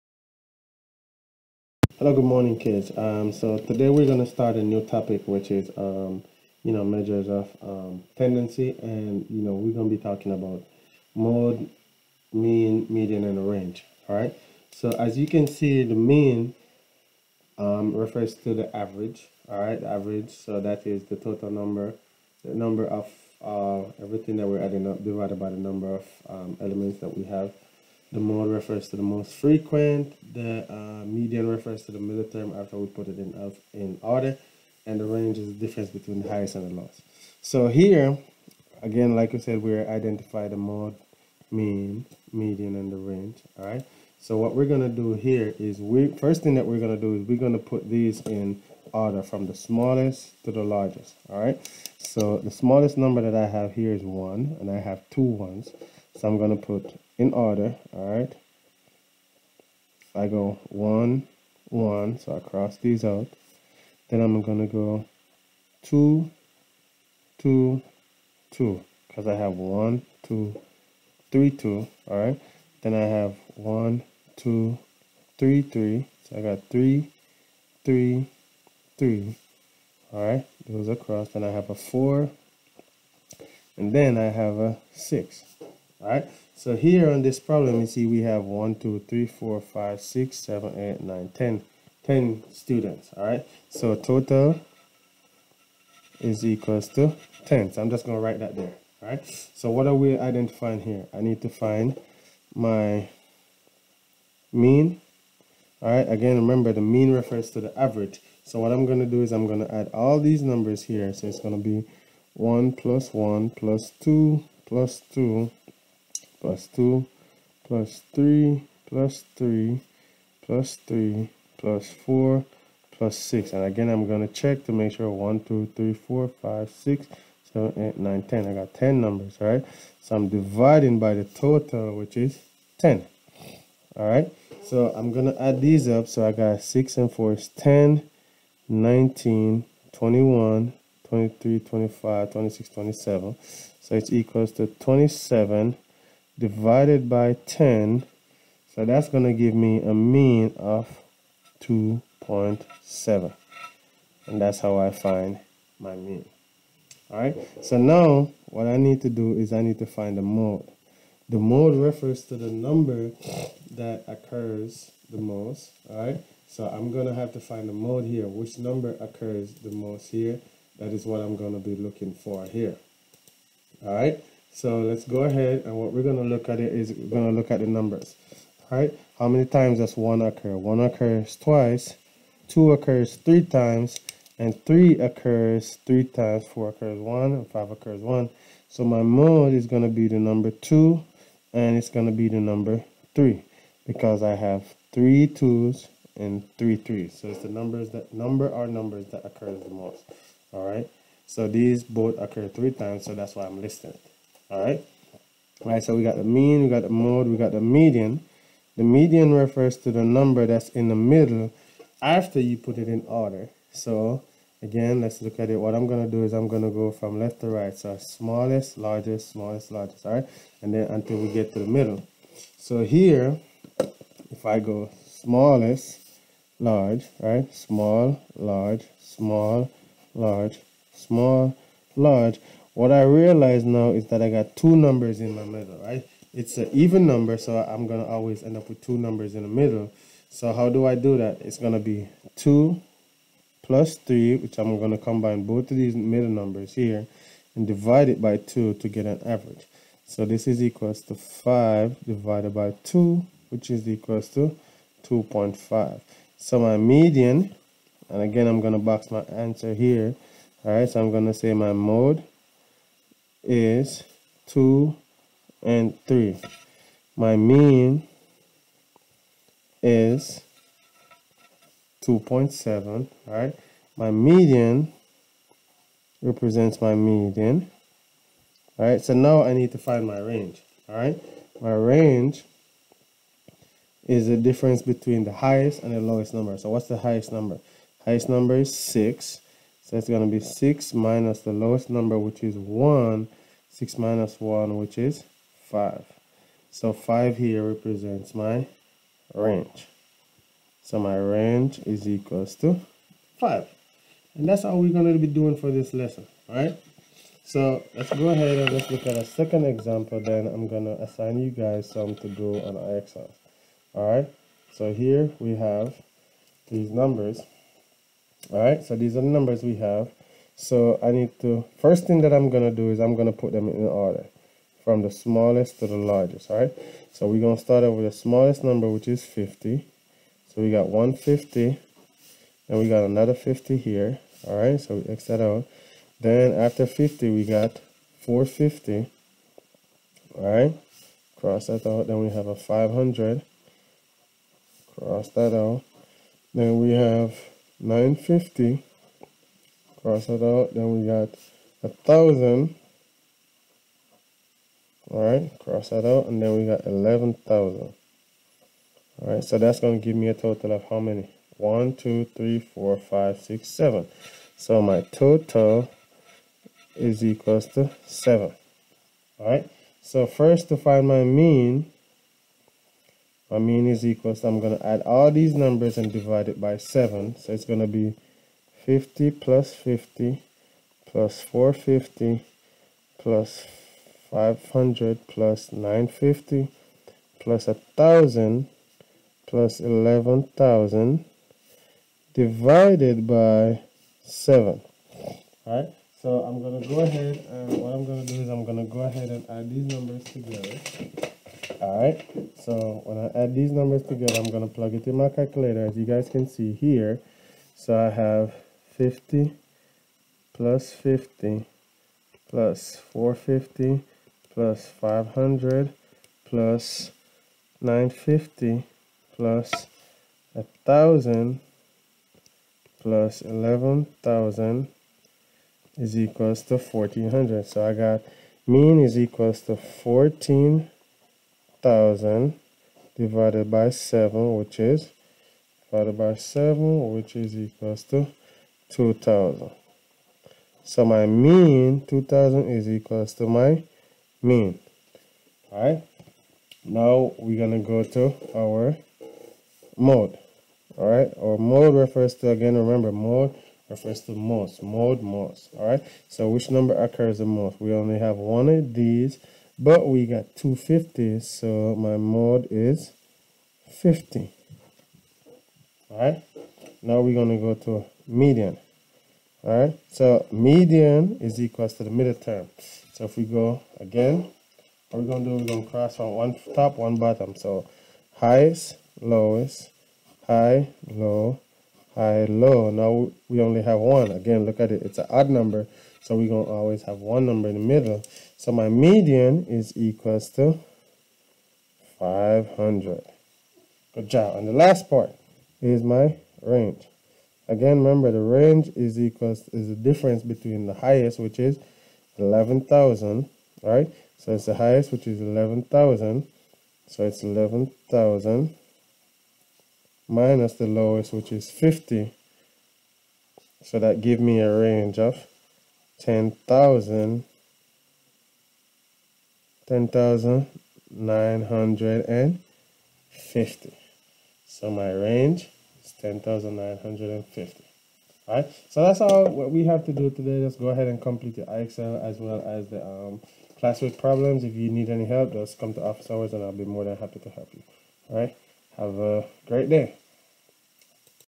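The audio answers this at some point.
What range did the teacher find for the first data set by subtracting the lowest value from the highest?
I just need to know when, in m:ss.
5:00.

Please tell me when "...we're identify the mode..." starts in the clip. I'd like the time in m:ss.
0:39.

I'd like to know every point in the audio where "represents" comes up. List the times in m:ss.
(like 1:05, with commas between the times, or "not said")
4:36, 4:57.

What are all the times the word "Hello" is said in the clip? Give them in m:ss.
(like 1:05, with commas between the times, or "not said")
0:02.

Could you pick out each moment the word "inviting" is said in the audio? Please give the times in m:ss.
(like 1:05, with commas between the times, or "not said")
not said.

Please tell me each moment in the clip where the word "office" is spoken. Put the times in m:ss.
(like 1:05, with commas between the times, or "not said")
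8:56.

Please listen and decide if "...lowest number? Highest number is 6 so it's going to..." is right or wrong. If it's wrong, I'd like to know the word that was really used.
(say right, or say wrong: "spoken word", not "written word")
wrong: "highest", not "lowest".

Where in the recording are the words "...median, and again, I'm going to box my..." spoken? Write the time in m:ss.
4:16.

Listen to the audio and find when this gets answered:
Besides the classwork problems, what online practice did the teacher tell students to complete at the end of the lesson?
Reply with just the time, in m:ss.
8:51.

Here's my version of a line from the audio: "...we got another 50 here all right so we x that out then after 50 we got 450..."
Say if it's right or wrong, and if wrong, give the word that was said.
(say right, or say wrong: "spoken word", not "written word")
right.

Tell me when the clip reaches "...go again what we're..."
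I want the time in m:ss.
7:53.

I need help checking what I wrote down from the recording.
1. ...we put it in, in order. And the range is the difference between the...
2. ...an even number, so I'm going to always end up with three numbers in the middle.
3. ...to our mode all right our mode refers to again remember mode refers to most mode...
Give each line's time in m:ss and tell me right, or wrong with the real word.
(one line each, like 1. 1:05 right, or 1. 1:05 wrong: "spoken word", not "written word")
1. 0:32 right
2. 3:56 wrong: "two", not "three"
3. 7:28 right.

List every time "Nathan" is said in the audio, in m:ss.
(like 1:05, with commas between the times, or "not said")
not said.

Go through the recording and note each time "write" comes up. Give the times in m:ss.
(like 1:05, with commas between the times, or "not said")
1:38.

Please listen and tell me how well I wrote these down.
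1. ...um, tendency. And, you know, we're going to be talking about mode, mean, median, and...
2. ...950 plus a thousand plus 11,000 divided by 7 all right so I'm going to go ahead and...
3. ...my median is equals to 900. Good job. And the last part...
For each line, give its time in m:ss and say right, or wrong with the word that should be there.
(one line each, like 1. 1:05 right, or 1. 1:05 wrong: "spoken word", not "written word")
1. 0:07 right
2. 6:25 right
3. 8:08 wrong: "500", not "900".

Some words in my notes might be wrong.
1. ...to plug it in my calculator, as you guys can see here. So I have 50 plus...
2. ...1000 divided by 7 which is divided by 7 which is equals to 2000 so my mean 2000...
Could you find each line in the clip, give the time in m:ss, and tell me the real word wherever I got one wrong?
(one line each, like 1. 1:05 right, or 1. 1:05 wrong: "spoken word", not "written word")
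1. 6:44 right
2. 7:11 right.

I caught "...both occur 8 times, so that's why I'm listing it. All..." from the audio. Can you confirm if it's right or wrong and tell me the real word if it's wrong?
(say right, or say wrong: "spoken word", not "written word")
wrong: "3", not "8".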